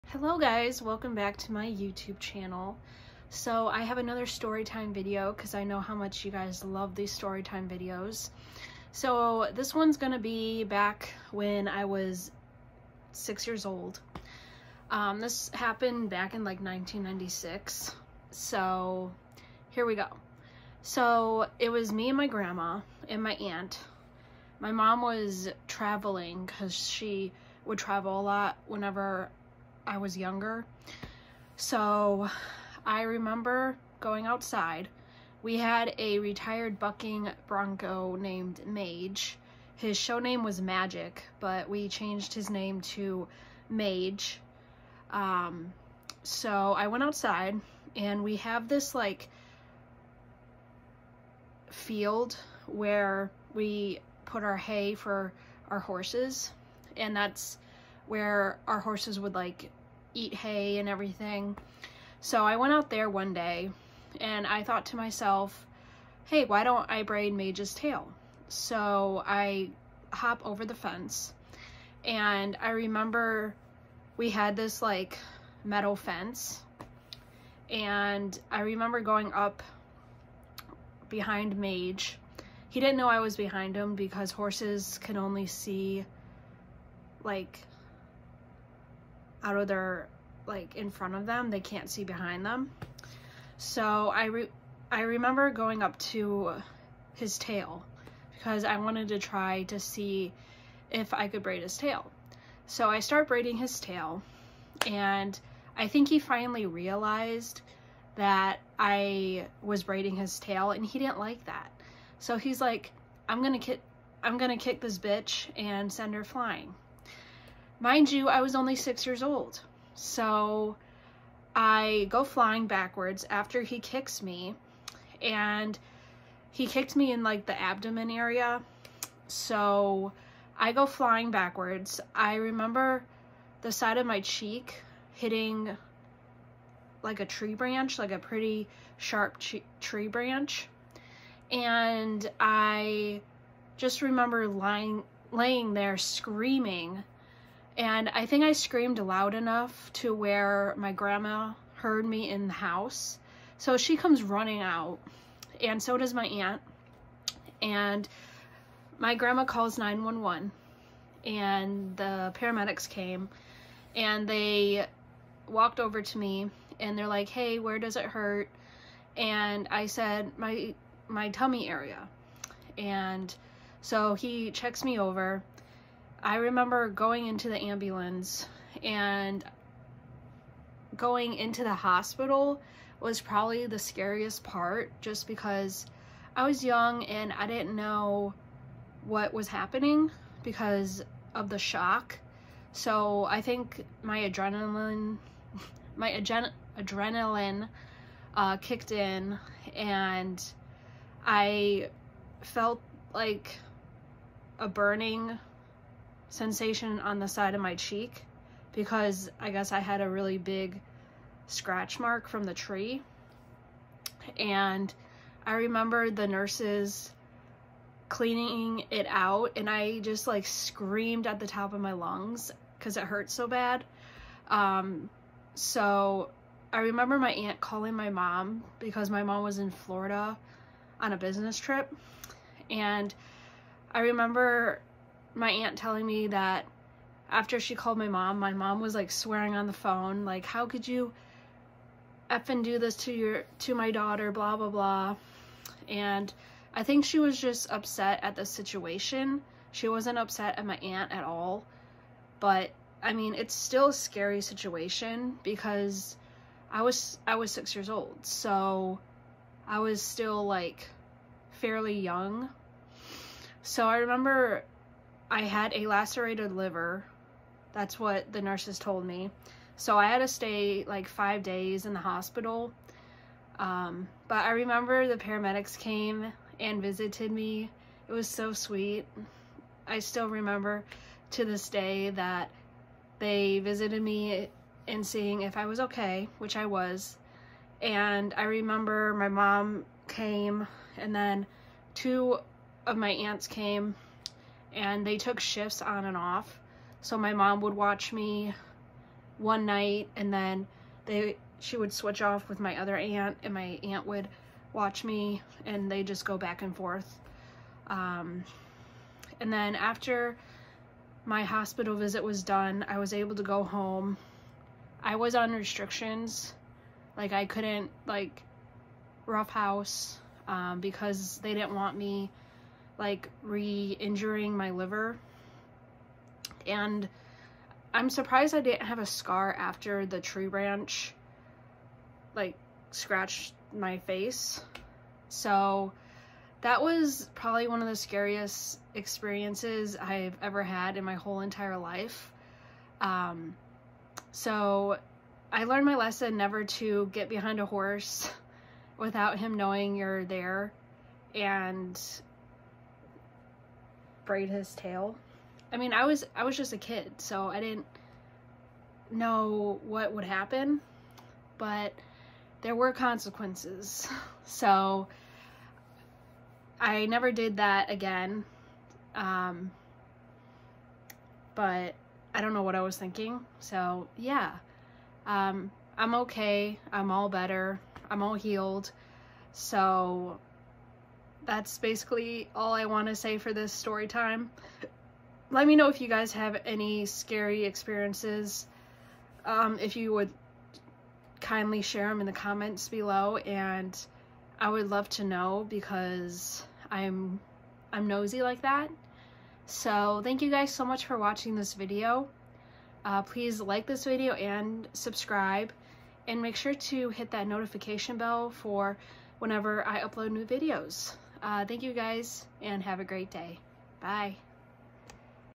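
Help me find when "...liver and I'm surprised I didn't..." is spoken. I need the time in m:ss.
5:24.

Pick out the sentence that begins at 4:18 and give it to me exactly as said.
So I was still like fairly young.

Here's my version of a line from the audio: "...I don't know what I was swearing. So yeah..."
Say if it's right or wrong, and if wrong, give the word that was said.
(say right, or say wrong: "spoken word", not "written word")
wrong: "thinking", not "swearing".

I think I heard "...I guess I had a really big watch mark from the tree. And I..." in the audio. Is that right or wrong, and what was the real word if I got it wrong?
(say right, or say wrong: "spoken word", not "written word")
wrong: "scratch", not "watch".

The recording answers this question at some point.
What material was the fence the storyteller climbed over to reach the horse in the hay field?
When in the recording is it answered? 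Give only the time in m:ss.
1:15.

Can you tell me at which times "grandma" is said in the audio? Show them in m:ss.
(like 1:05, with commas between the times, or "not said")
0:22, 2:30, 2:39.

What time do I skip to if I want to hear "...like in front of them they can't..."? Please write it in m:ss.
1:30.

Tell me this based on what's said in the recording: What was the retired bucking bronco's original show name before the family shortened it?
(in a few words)
Magic.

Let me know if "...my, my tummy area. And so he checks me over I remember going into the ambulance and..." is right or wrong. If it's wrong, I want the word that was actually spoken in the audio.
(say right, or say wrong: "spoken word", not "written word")
right.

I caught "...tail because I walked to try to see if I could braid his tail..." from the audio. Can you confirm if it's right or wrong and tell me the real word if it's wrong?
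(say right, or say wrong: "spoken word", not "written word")
wrong: "wanted", not "walked".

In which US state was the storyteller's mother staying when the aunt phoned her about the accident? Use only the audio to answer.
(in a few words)
Florida.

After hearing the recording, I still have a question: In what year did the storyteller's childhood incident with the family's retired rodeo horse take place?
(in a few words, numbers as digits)
1996.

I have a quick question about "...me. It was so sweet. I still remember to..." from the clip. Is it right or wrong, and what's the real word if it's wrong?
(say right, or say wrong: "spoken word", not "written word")
right.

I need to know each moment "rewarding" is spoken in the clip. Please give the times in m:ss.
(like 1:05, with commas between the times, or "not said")
not said.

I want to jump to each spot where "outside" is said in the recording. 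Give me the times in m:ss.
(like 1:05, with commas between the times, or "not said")
0:34, 0:47.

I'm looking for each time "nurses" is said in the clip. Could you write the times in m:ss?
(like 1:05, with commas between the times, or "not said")
3:36, 4:28.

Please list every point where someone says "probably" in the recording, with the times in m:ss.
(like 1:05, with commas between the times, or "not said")
3:03, 5:37.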